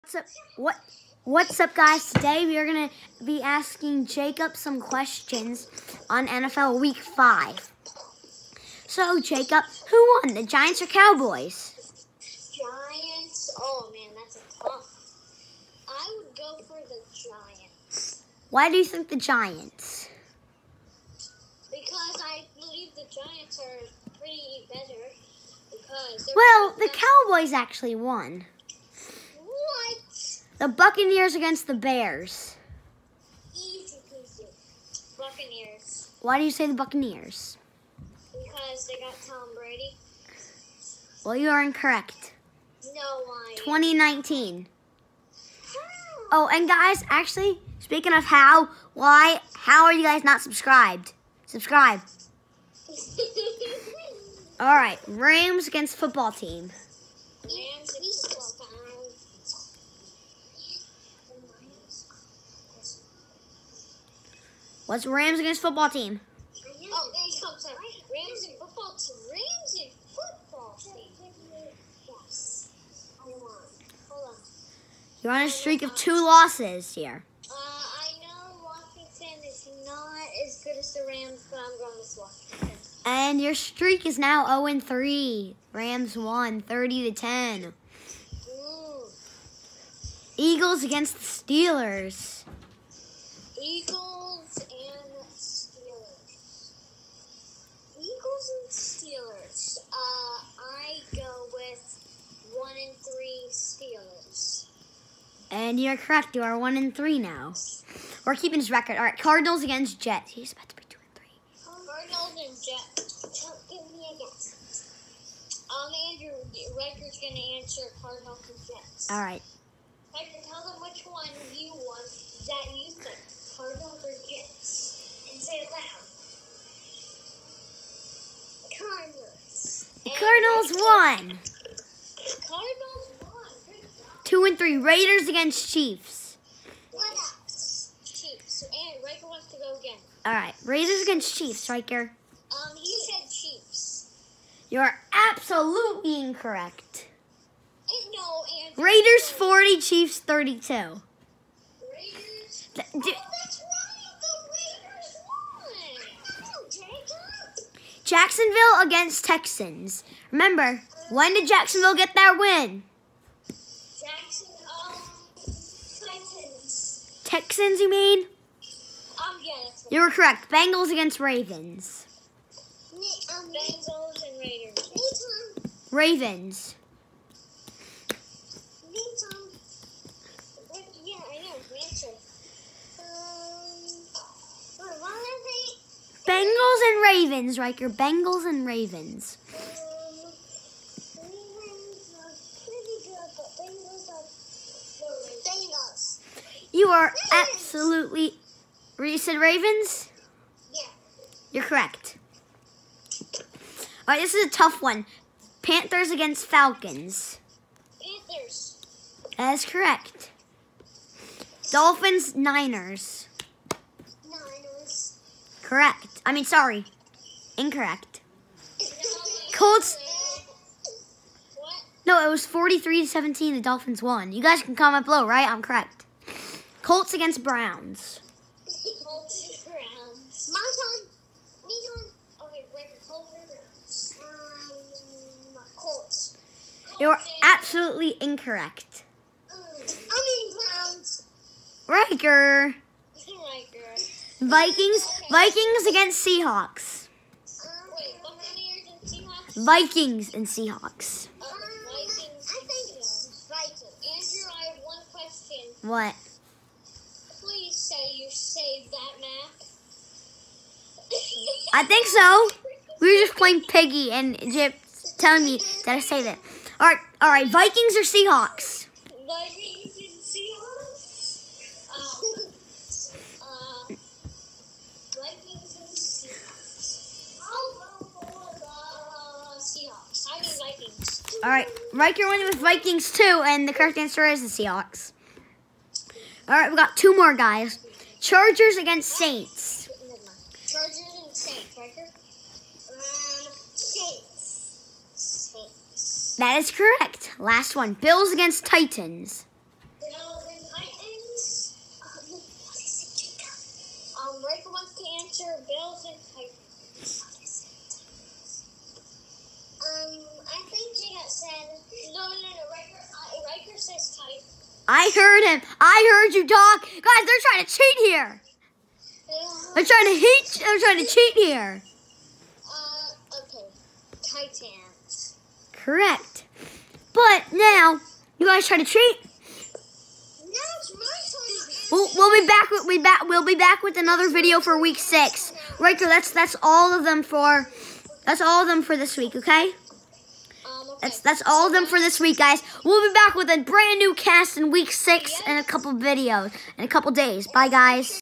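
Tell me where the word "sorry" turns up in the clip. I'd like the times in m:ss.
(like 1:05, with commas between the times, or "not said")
3:36.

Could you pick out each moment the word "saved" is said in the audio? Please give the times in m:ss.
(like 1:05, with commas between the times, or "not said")
4:18, 4:25.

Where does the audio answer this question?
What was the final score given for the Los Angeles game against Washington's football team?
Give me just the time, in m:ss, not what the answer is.
1:26.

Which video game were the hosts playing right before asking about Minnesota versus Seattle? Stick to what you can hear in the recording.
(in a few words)
Piggy.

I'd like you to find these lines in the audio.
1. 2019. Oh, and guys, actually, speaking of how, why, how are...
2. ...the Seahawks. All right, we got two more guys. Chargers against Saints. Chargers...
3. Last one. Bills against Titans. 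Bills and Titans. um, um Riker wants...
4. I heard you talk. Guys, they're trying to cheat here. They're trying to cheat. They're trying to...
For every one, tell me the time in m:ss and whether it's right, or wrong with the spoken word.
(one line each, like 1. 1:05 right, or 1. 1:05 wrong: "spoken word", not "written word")
1. 0:43 right
2. 4:44 right
3. 4:57 right
4. 5:15 right.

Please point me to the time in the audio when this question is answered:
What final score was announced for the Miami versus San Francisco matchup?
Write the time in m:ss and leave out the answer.
3:42.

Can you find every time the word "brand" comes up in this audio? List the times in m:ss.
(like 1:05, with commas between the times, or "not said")
5:43.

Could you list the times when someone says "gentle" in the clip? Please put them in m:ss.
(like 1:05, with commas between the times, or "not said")
not said.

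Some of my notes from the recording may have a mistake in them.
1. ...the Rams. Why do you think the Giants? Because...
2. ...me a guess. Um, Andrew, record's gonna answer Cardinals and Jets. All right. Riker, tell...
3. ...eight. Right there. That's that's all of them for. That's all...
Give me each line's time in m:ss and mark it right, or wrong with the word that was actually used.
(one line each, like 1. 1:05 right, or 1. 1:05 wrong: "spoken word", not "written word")
1. 0:16 wrong: "Giants", not "Rams"
2. 1:53 right
3. 5:34 wrong: "six", not "eight".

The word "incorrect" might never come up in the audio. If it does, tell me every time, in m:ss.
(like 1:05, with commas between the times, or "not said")
0:41, 2:26, 3:37, 3:58.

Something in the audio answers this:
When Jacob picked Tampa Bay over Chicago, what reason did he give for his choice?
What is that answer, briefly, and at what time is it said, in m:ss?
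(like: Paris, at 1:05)
They got Tom Brady, at 0:38.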